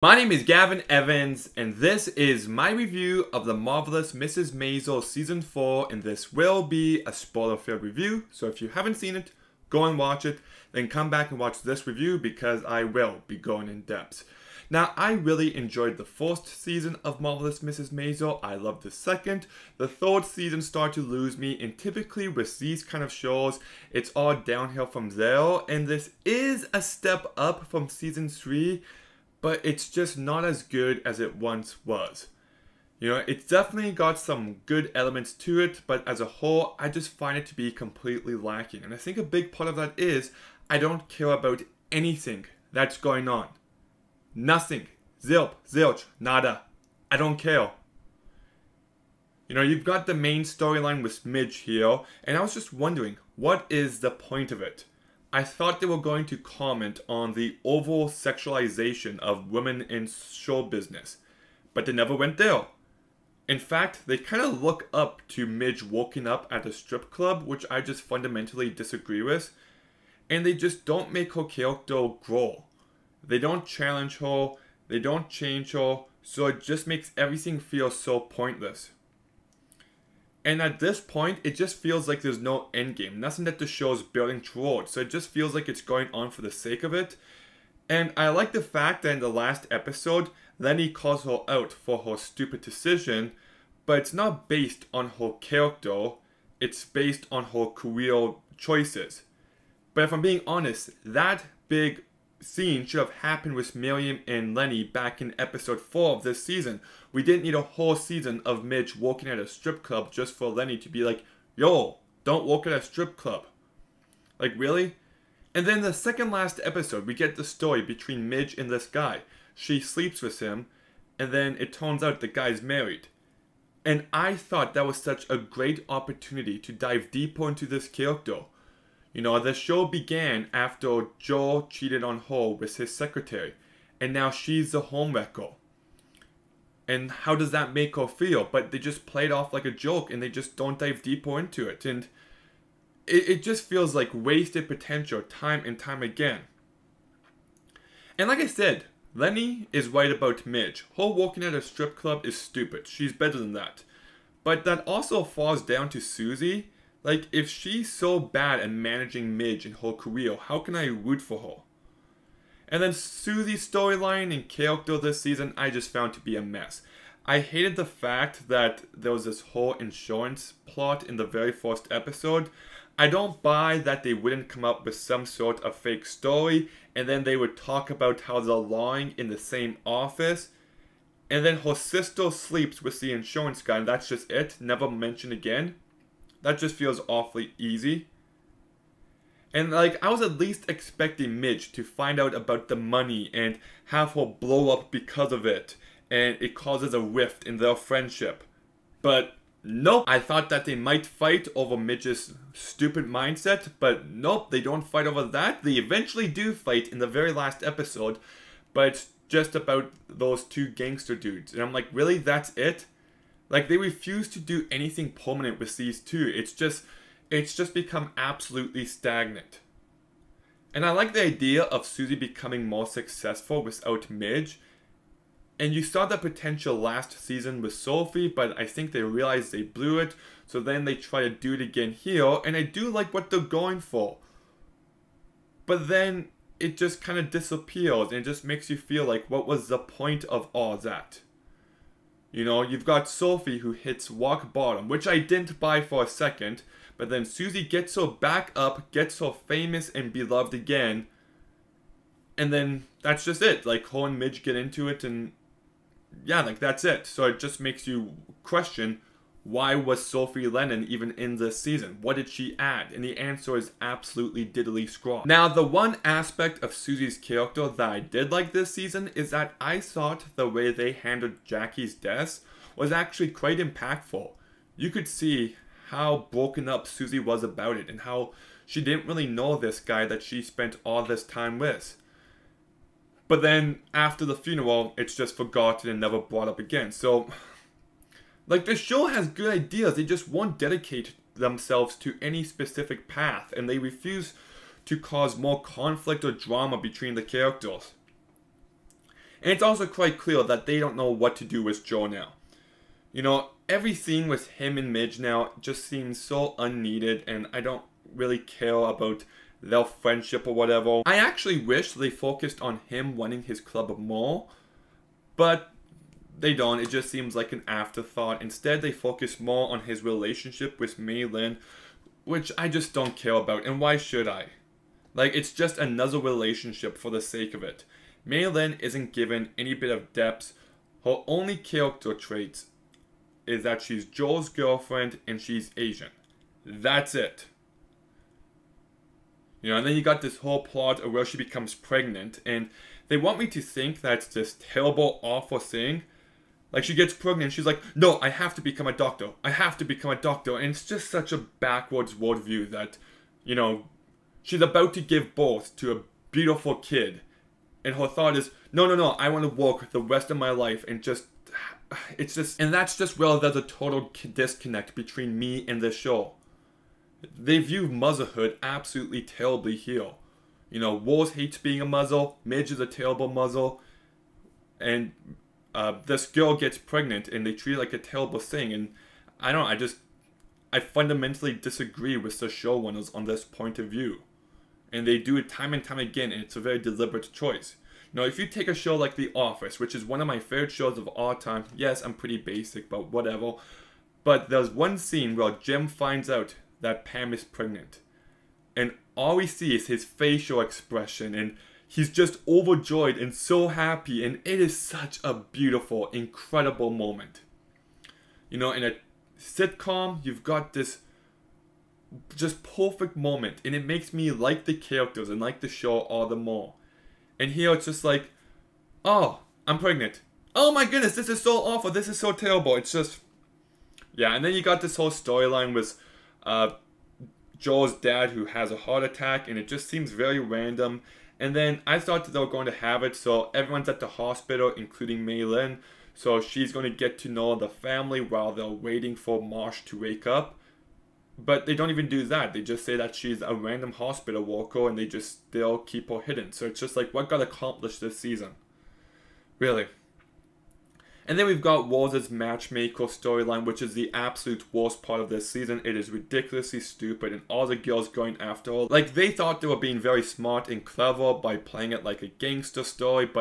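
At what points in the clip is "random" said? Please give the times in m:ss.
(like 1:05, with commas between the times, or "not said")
7:10, 7:23.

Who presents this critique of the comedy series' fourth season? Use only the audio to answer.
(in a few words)
Gavin Evans.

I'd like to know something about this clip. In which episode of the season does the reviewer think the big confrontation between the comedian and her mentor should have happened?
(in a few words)
Episode 4.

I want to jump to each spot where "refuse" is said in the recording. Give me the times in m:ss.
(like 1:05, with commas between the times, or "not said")
3:33, 4:53.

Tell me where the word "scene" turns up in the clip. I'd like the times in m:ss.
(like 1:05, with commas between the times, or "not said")
1:42, 5:03, 6:34.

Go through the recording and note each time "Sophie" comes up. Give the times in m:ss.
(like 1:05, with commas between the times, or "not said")
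3:47, 4:03, 4:20.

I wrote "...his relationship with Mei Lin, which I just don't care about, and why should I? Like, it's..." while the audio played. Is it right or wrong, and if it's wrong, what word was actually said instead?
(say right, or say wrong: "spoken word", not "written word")
right.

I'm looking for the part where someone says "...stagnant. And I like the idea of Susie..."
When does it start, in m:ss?
3:38.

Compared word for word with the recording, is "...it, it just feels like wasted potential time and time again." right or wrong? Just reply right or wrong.
right.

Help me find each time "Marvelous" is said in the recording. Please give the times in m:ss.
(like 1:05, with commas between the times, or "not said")
0:03, 0:17.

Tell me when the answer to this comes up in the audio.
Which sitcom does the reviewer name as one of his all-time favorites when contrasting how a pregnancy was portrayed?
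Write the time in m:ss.
6:29.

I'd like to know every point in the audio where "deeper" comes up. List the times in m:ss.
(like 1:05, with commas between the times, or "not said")
2:07, 2:21.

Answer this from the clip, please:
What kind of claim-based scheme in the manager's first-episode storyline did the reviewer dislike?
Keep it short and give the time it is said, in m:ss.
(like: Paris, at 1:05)
Insurance plot, at 2:49.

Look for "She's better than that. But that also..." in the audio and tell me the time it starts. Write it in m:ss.
2:32.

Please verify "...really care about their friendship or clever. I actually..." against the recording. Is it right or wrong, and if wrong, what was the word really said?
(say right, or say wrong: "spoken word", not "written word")
wrong: "whatever", not "clever".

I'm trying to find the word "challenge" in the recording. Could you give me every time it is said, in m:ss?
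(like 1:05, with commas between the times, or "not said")
1:13.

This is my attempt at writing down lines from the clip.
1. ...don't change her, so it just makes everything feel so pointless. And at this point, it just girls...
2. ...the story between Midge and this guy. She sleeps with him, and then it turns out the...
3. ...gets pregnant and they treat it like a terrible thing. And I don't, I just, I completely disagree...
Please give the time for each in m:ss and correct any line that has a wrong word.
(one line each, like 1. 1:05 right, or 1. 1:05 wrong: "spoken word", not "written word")
1. 1:14 wrong: "feels", not "girls"
2. 1:57 right
3. 6:16 wrong: "fundamentally", not "completely".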